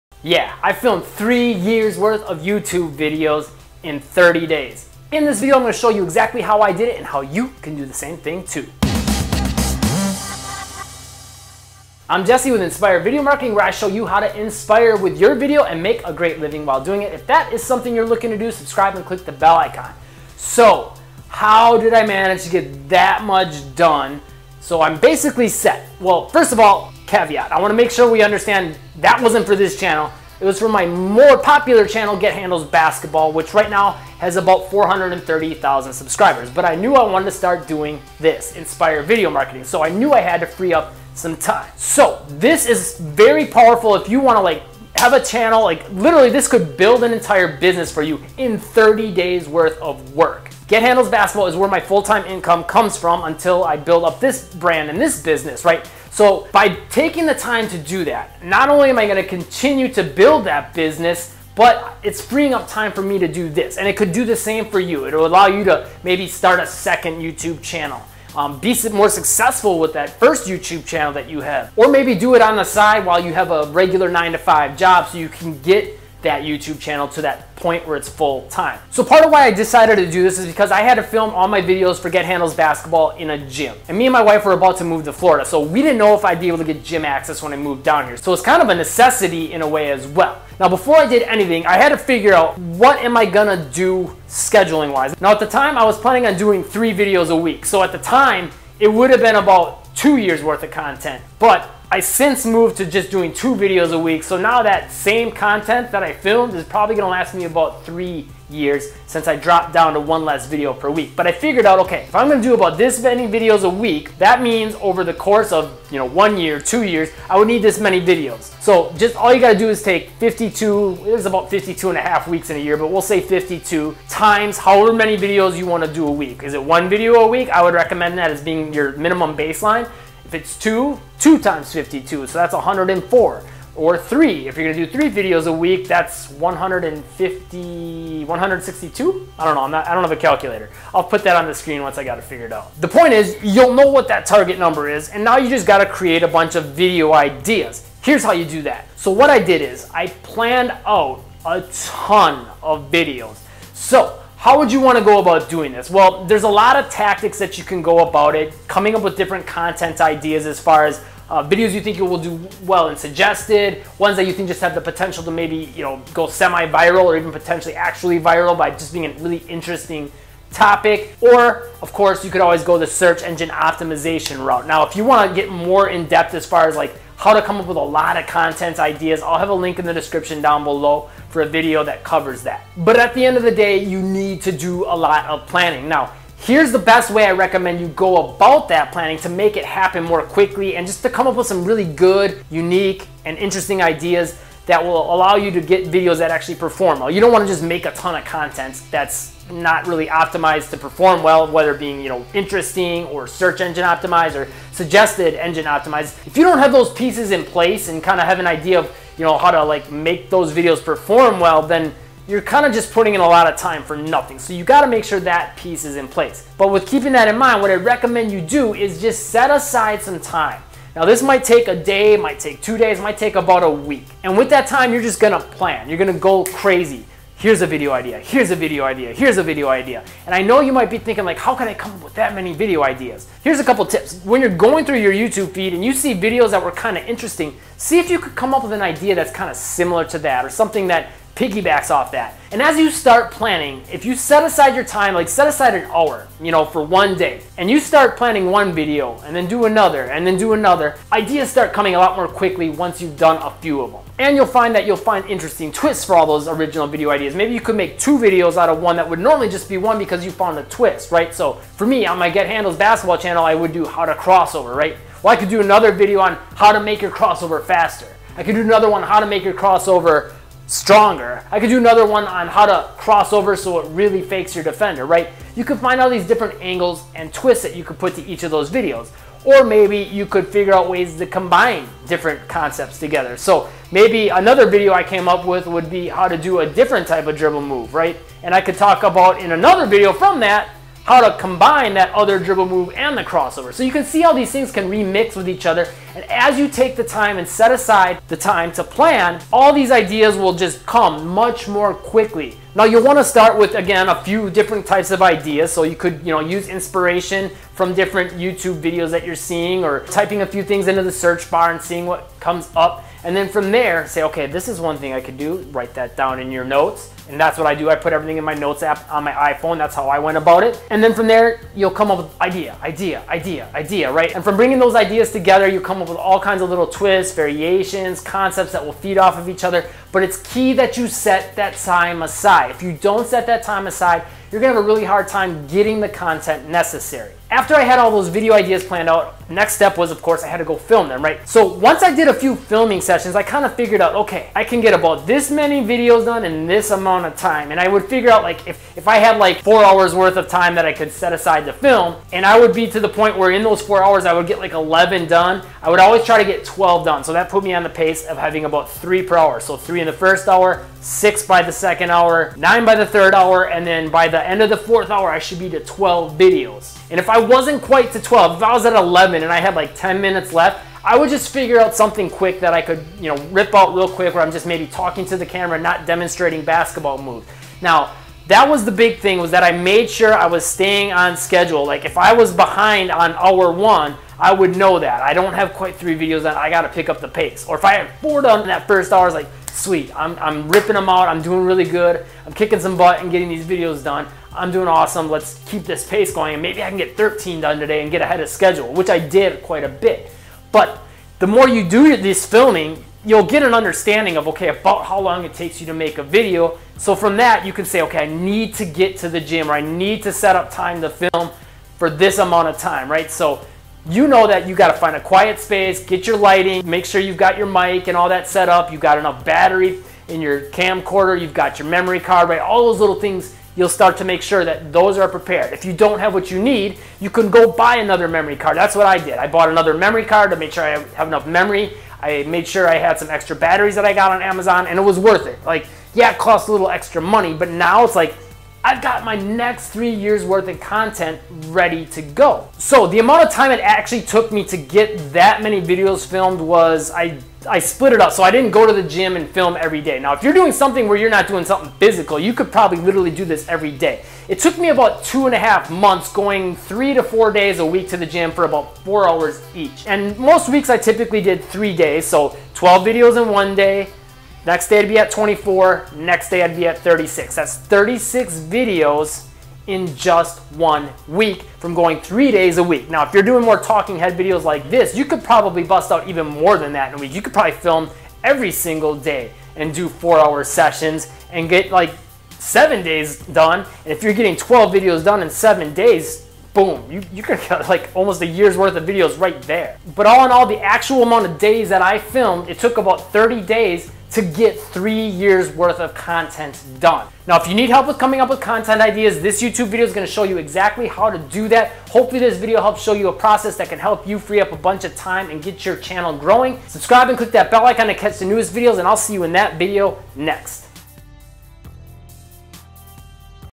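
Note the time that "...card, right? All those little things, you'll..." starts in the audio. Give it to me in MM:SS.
07:02.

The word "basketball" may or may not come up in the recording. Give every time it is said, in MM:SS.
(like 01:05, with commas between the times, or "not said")
00:32, 00:51, 01:22, 04:22, 06:16.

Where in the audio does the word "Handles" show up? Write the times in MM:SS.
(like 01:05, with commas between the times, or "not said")
00:32, 00:50, 01:22, 04:22.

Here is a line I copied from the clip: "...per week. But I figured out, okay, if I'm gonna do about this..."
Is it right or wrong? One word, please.
right.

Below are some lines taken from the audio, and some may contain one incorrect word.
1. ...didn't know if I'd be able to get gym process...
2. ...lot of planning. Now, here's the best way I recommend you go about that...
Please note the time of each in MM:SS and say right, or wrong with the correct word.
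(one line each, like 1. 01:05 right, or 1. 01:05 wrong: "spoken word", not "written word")
1. 01:25 wrong: "access", not "process"
2. 03:04 right.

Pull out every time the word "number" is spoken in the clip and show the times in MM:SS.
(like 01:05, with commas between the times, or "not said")
02:24.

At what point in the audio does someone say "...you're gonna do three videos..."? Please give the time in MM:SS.
02:14.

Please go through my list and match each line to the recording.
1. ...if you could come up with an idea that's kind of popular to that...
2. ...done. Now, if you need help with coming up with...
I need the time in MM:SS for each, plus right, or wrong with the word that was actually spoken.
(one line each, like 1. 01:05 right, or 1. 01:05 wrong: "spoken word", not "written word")
1. 03:57 wrong: "similar", not "popular"
2. 08:16 right.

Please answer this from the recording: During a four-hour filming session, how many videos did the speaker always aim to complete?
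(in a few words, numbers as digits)
12.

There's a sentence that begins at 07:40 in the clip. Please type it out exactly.
And most weeks I typically did three days.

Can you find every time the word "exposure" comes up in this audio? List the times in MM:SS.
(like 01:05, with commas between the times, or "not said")
not said.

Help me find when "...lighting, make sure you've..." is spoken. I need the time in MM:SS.
06:56.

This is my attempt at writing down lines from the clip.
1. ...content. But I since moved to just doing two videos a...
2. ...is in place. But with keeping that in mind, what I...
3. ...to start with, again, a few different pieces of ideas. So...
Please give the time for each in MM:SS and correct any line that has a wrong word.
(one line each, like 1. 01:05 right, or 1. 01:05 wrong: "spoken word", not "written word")
1. 01:40 right
2. 03:35 right
3. 05:03 wrong: "types", not "pieces".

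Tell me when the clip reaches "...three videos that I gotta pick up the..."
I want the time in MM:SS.
06:25.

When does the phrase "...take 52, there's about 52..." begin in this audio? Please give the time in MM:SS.
01:59.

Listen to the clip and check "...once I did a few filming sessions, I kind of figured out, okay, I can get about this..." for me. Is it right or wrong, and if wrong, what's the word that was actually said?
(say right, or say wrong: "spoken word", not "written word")
right.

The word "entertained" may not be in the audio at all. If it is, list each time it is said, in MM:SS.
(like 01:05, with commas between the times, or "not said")
not said.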